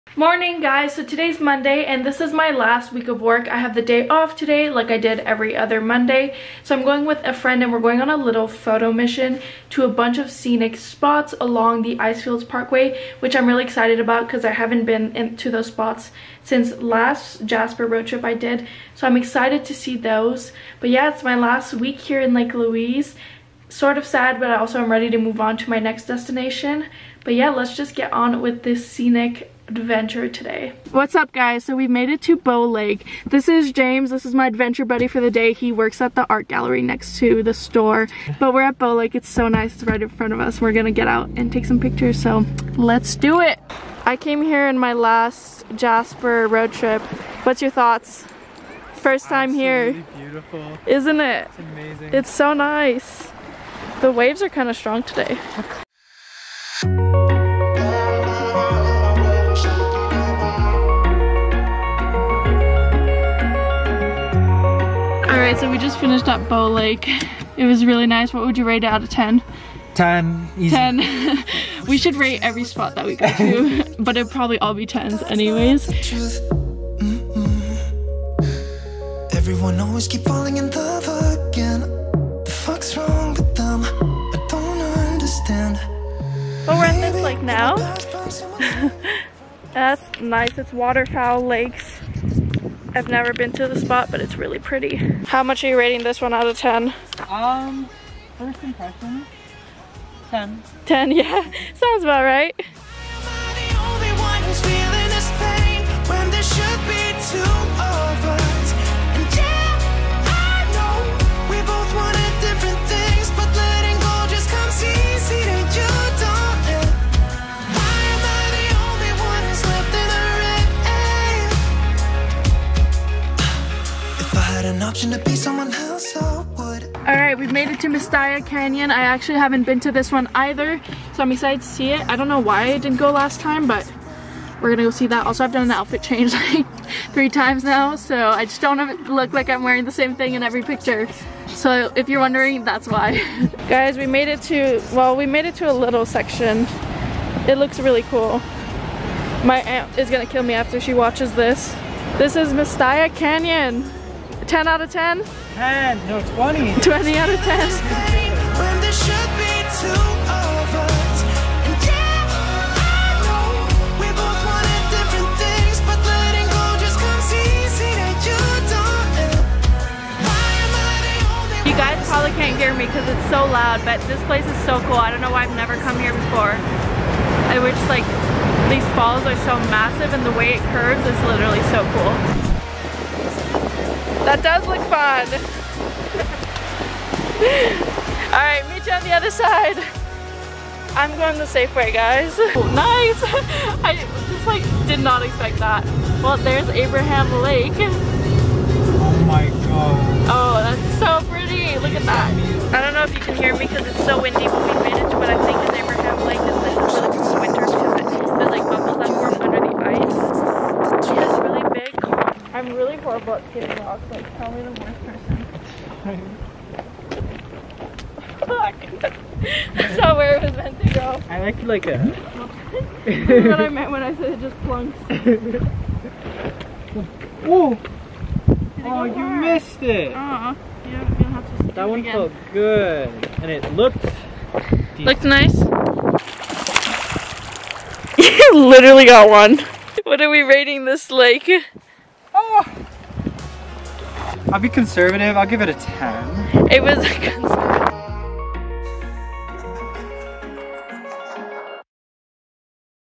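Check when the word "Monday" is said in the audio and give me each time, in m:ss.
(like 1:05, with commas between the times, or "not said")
0:01, 0:05.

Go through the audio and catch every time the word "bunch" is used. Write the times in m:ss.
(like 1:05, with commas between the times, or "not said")
0:09.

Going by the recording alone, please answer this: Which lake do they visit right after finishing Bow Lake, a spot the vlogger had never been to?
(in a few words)
Waterfowl Lakes.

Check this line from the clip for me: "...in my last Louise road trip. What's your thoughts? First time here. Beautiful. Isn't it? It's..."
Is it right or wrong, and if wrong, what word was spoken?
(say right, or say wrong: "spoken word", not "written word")
wrong: "Jasper", not "Louise".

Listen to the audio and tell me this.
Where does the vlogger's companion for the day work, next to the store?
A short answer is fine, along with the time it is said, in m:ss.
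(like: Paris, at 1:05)
the art gallery, at 0:36.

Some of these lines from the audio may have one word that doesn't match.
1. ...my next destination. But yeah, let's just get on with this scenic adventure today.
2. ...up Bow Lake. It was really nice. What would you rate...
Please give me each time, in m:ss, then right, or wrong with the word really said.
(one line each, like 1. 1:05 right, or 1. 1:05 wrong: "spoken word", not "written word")
1. 0:25 right
2. 1:06 right.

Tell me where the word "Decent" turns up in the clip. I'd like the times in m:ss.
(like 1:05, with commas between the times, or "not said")
3:54.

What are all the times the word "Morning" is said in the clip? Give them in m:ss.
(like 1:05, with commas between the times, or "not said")
0:00.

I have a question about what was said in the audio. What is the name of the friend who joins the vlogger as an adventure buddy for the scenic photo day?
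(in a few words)
James.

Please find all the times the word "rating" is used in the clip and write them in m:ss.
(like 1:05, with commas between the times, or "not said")
1:35, 4:00.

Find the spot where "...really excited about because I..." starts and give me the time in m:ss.
0:13.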